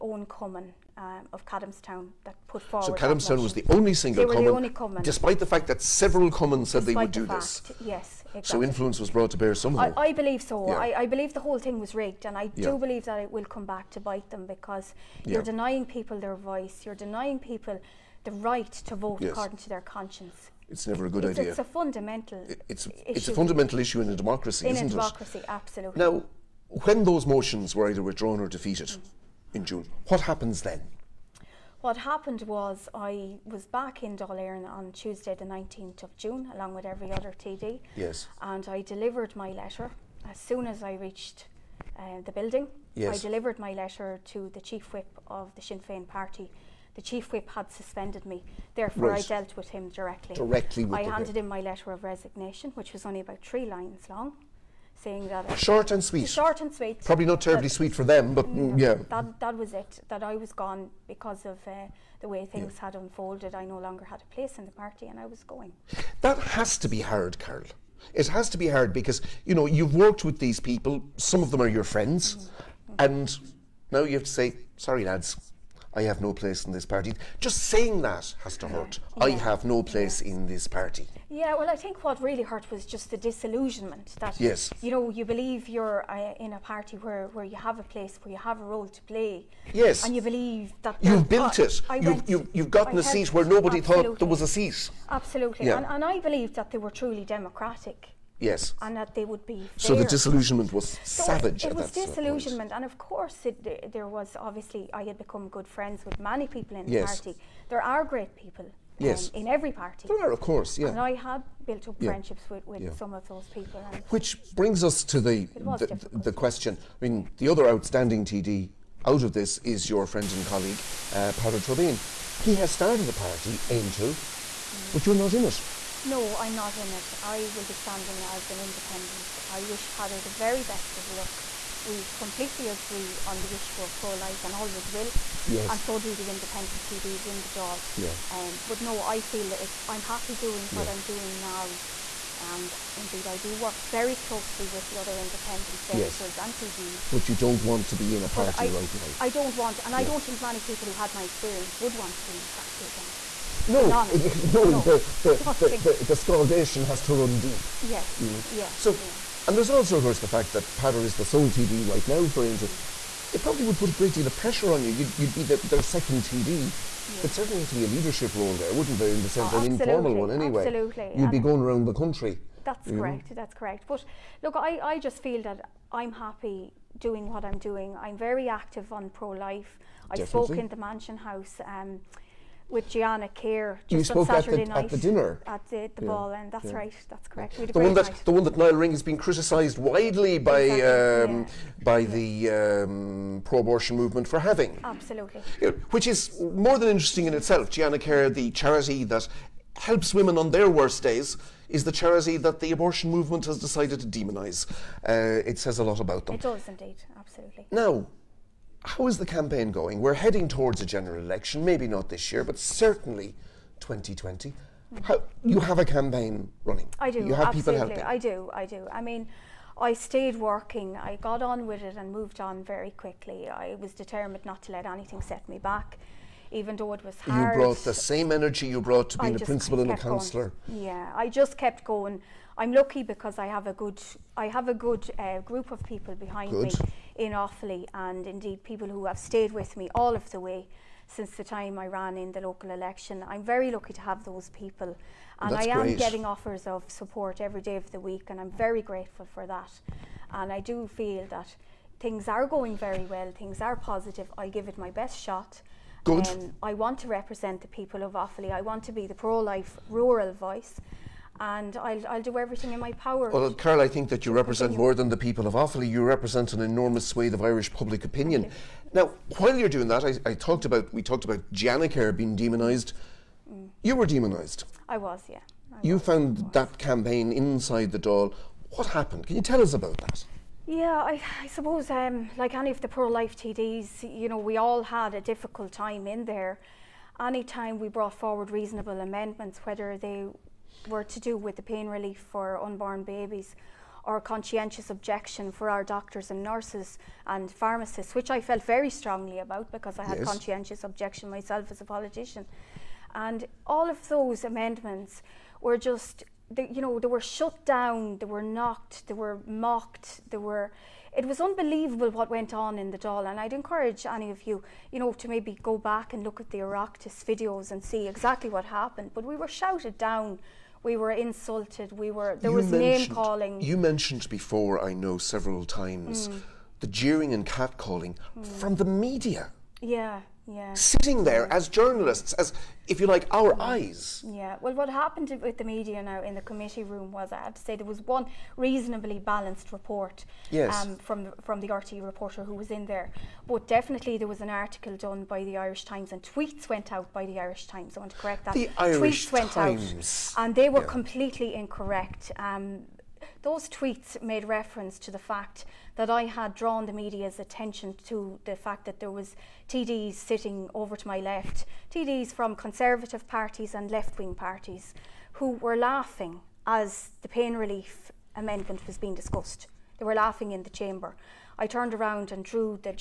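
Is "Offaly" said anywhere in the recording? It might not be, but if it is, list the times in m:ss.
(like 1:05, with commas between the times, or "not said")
3:57, 4:18, 4:25.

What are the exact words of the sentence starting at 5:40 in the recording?
um, from, the, from the RTÉ reporter who was in there.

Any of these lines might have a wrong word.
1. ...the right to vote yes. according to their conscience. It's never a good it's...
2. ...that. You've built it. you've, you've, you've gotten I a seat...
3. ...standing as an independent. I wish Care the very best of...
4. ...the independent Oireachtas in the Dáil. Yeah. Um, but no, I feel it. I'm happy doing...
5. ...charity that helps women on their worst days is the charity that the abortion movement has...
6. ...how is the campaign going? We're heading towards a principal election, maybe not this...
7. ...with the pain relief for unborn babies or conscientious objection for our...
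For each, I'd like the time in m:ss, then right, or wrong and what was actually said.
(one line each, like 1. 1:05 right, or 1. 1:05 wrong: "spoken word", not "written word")
1. 0:18 right
2. 1:30 right
3. 2:07 wrong: "Peadar", not "Care"
4. 2:16 wrong: "TDs", not "Oireachtas"
5. 3:18 right
6. 3:28 wrong: "general", not "principal"
7. 4:51 right.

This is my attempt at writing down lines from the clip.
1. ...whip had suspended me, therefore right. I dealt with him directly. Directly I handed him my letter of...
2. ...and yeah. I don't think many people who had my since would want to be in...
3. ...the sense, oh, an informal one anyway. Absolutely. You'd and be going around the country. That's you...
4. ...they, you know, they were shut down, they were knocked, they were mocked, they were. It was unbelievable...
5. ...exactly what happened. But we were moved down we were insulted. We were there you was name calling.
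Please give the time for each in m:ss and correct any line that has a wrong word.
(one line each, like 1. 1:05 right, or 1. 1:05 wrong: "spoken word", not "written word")
1. 0:47 right
2. 2:29 wrong: "experience", not "since"
3. 2:49 right
4. 5:06 right
5. 5:18 wrong: "shouted", not "moved".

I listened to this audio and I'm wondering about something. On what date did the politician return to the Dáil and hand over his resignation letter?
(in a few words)
Tuesday the 19th of June.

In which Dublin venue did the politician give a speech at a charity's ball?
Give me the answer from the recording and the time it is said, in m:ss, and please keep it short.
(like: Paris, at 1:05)
Mansion House, at 3:00.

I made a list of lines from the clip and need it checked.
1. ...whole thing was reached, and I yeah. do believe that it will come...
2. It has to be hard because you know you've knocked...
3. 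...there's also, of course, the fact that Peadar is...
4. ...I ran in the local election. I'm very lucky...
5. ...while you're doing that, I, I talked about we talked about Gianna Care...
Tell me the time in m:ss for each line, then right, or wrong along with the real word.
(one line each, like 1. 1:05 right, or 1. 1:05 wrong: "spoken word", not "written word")
1. 0:11 wrong: "rigged", not "reached"
2. 1:08 wrong: "worked", not "knocked"
3. 2:39 right
4. 4:01 right
5. 4:29 right.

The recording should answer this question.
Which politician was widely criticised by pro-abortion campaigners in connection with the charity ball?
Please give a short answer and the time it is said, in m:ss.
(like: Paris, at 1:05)
Nial Ring, at 3:08.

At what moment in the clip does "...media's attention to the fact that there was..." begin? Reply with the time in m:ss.
5:56.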